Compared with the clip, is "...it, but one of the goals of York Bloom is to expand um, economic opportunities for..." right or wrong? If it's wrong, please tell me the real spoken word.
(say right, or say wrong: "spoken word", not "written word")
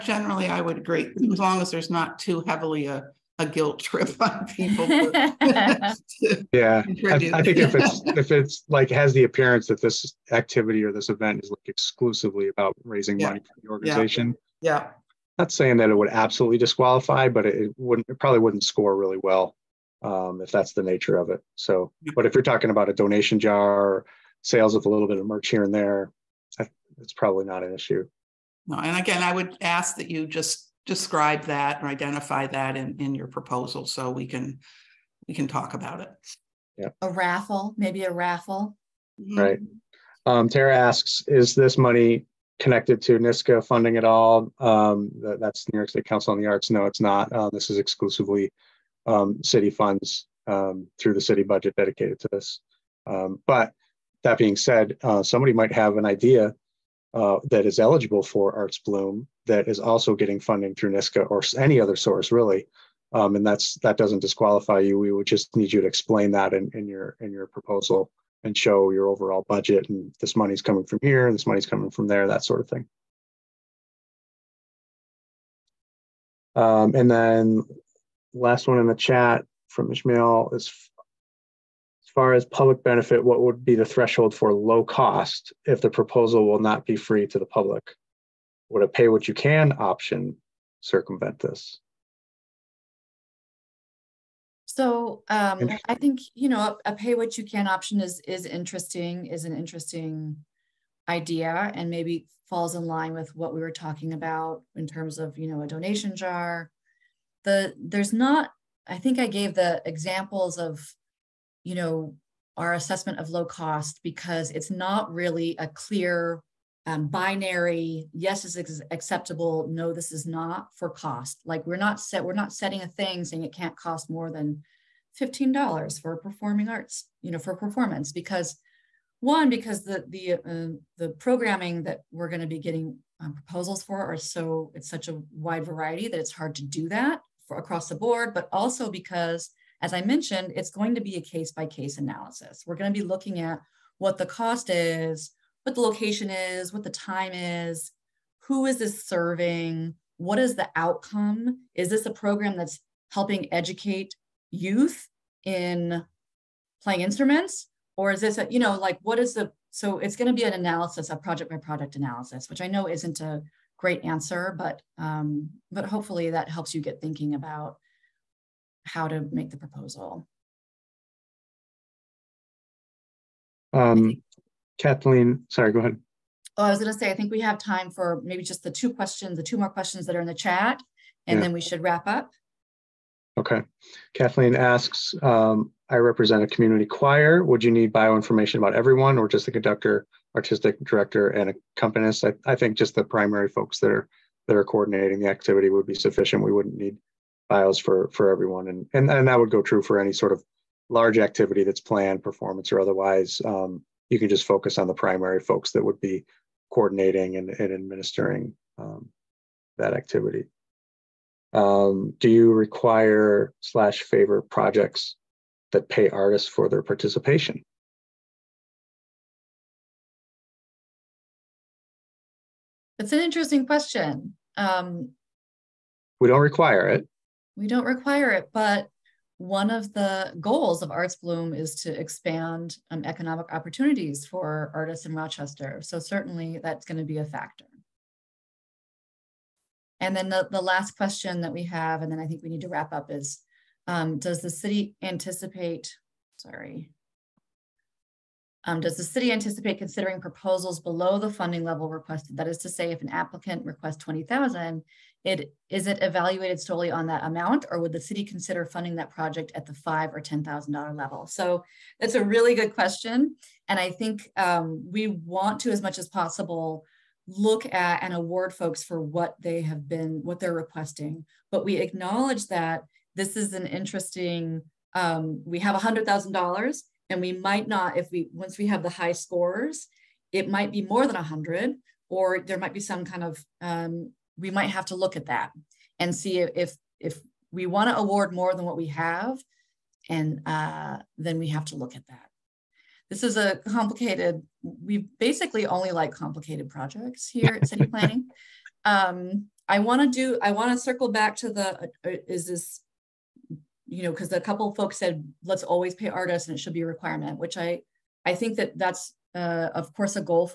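wrong: "Arts", not "York".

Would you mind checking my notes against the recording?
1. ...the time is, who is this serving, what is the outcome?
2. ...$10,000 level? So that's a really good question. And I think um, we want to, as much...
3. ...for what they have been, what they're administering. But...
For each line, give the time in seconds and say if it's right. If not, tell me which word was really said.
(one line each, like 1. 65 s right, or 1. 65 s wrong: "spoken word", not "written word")
1. 146 s right
2. 260 s right
3. 268 s wrong: "requesting", not "administering".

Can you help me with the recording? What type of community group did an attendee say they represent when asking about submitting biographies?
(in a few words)
community choir.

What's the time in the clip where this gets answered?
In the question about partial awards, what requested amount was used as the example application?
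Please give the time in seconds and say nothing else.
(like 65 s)
253 s.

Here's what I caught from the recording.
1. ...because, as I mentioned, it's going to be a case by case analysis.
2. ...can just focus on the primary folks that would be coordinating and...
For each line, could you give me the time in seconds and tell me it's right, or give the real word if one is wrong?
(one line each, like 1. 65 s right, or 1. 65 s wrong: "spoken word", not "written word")
1. 138 s right
2. 204 s right.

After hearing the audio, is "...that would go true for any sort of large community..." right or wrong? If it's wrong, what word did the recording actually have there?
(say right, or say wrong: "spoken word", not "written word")
wrong: "activity", not "community".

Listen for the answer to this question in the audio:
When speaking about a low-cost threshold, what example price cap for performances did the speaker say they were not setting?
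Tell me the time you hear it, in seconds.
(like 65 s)
125 s.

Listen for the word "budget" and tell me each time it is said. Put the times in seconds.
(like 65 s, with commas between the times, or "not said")
51 s, 69 s.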